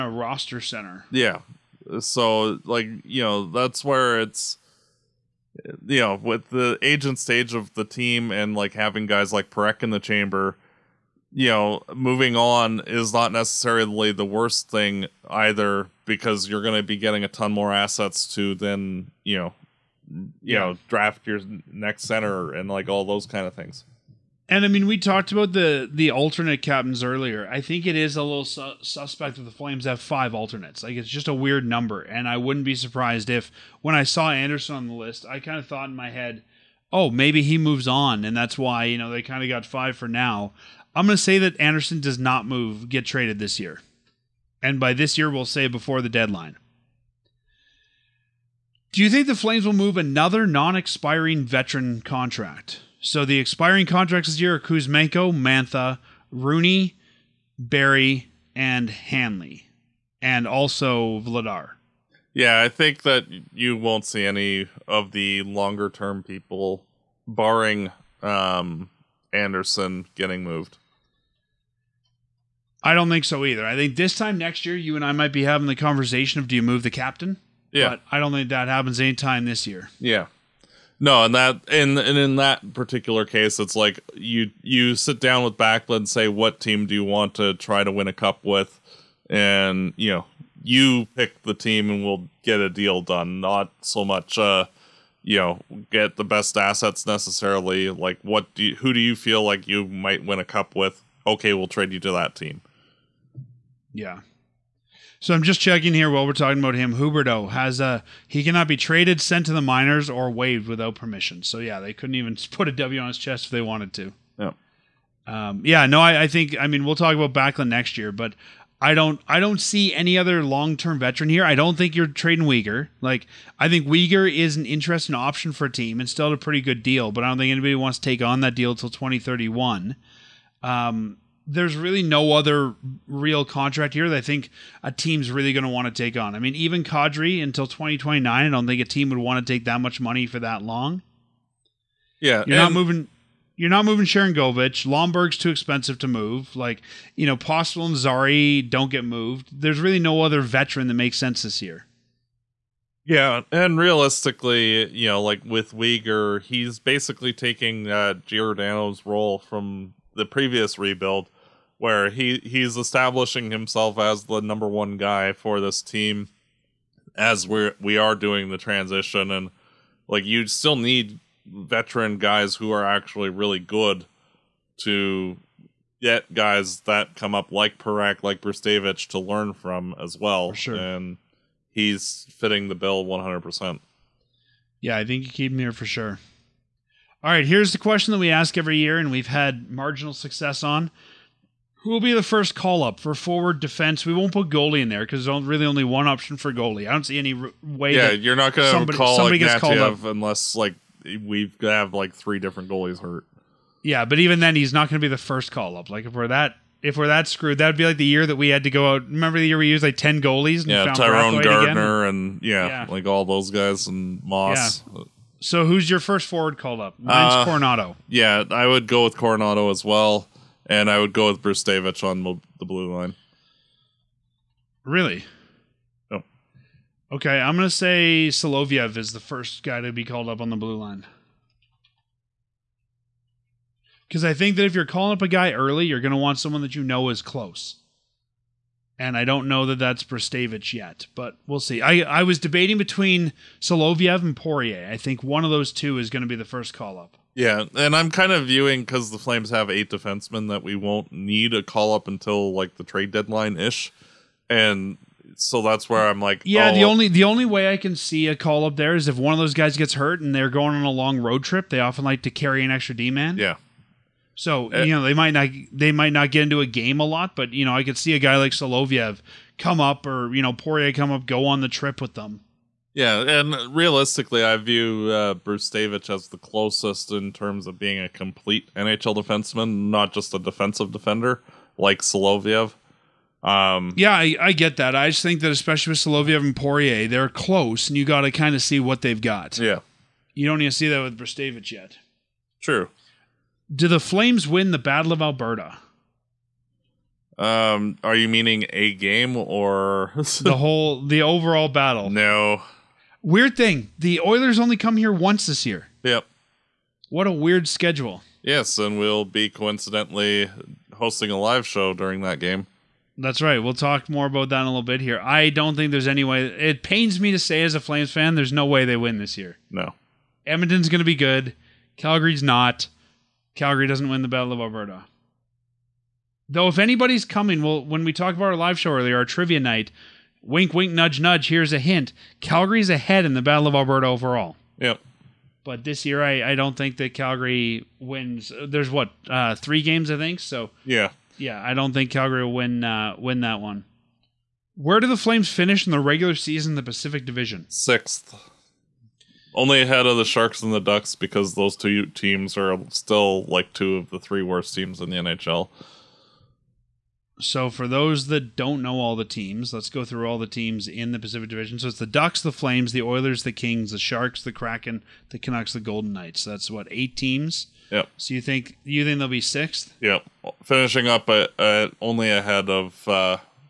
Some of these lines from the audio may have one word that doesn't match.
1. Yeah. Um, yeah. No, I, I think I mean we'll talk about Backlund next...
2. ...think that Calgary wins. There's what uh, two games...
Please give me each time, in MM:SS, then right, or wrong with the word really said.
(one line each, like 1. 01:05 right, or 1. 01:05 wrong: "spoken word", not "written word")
1. 01:54 right
2. 05:36 wrong: "three", not "two".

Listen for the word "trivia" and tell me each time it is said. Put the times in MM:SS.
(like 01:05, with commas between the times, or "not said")
05:29.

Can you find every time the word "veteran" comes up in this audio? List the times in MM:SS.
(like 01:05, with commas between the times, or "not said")
00:51, 02:00, 02:30, 02:51.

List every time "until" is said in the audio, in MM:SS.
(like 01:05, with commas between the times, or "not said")
02:08, 02:17, 04:12.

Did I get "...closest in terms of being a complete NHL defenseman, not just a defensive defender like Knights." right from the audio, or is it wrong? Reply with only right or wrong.
wrong.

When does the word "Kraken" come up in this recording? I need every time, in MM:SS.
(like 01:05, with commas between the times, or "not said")
06:04.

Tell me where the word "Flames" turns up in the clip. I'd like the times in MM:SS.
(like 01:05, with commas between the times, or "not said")
00:29, 00:49, 04:09, 04:53, 05:17, 05:45, 06:02.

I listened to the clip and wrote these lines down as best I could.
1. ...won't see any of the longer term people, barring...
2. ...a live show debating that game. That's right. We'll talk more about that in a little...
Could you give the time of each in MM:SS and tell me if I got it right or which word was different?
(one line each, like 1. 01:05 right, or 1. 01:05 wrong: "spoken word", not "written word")
1. 01:03 right
2. 05:11 wrong: "during", not "debating".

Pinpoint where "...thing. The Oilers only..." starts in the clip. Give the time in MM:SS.
05:03.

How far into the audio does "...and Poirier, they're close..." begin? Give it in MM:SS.
04:46.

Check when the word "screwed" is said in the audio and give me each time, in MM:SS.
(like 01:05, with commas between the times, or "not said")
03:27.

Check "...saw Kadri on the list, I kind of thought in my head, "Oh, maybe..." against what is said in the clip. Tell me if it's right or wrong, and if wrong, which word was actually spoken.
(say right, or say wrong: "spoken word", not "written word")
wrong: "Andersson", not "Kadri".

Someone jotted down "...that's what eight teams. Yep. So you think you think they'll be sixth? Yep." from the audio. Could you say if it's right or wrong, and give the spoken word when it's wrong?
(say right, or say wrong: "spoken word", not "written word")
right.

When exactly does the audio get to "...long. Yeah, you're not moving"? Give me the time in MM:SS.
02:20.